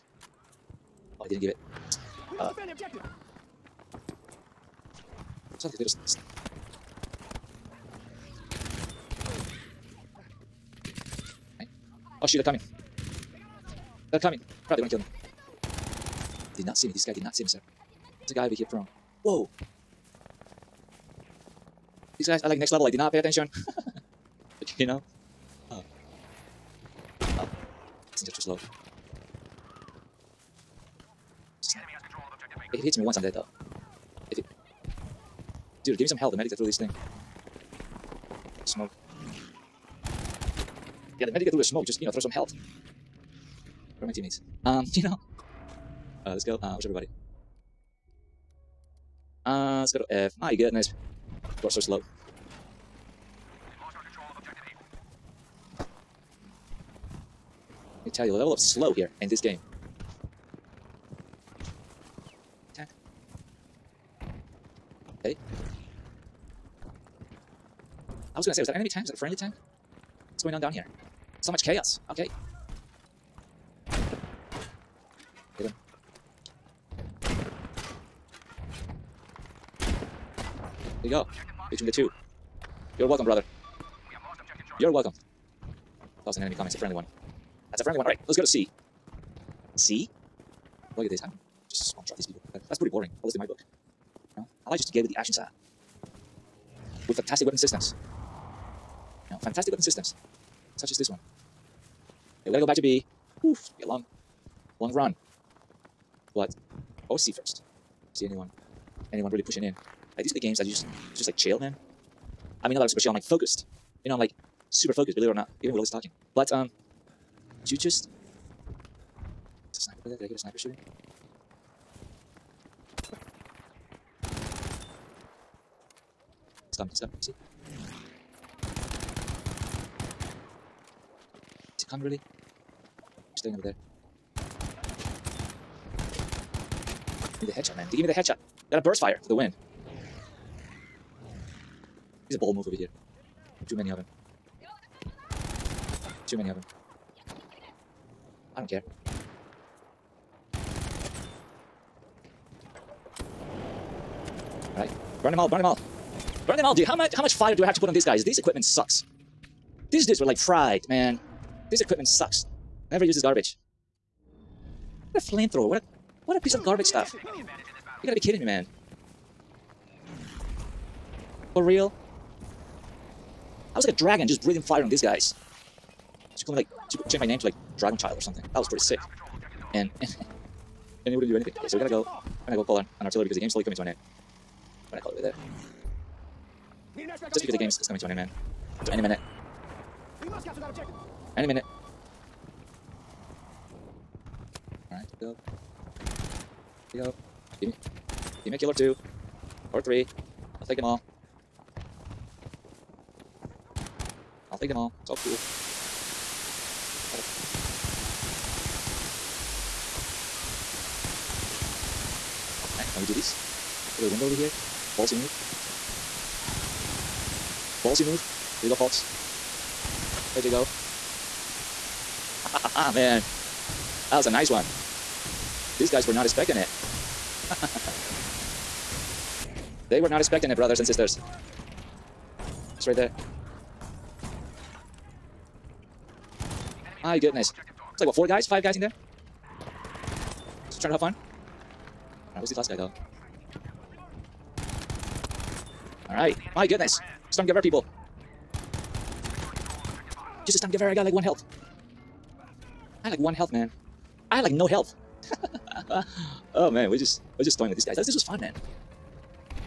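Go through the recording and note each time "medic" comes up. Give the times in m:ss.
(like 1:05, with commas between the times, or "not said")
0:36, 0:41.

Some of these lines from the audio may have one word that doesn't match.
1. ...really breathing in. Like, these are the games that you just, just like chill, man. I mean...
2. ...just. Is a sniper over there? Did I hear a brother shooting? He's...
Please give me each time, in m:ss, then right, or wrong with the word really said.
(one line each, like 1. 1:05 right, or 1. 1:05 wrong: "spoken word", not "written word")
1. 1:49 wrong: "pushing", not "breathing"
2. 1:57 wrong: "sniper", not "brother".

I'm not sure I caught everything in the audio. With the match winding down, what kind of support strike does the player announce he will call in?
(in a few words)
Artillery.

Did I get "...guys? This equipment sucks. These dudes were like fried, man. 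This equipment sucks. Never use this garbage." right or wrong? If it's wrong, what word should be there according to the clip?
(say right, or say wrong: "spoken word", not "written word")
right.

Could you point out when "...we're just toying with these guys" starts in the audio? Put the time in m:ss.
4:17.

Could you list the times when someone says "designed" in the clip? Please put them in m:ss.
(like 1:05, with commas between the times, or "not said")
not said.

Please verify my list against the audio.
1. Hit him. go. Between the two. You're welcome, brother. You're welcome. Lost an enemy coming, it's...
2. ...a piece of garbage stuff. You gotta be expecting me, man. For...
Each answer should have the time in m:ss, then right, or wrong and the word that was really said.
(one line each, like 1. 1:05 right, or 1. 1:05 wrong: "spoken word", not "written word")
1. 1:15 right
2. 2:46 wrong: "kidding", not "expecting".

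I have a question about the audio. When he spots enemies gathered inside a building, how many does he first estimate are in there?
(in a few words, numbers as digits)
4.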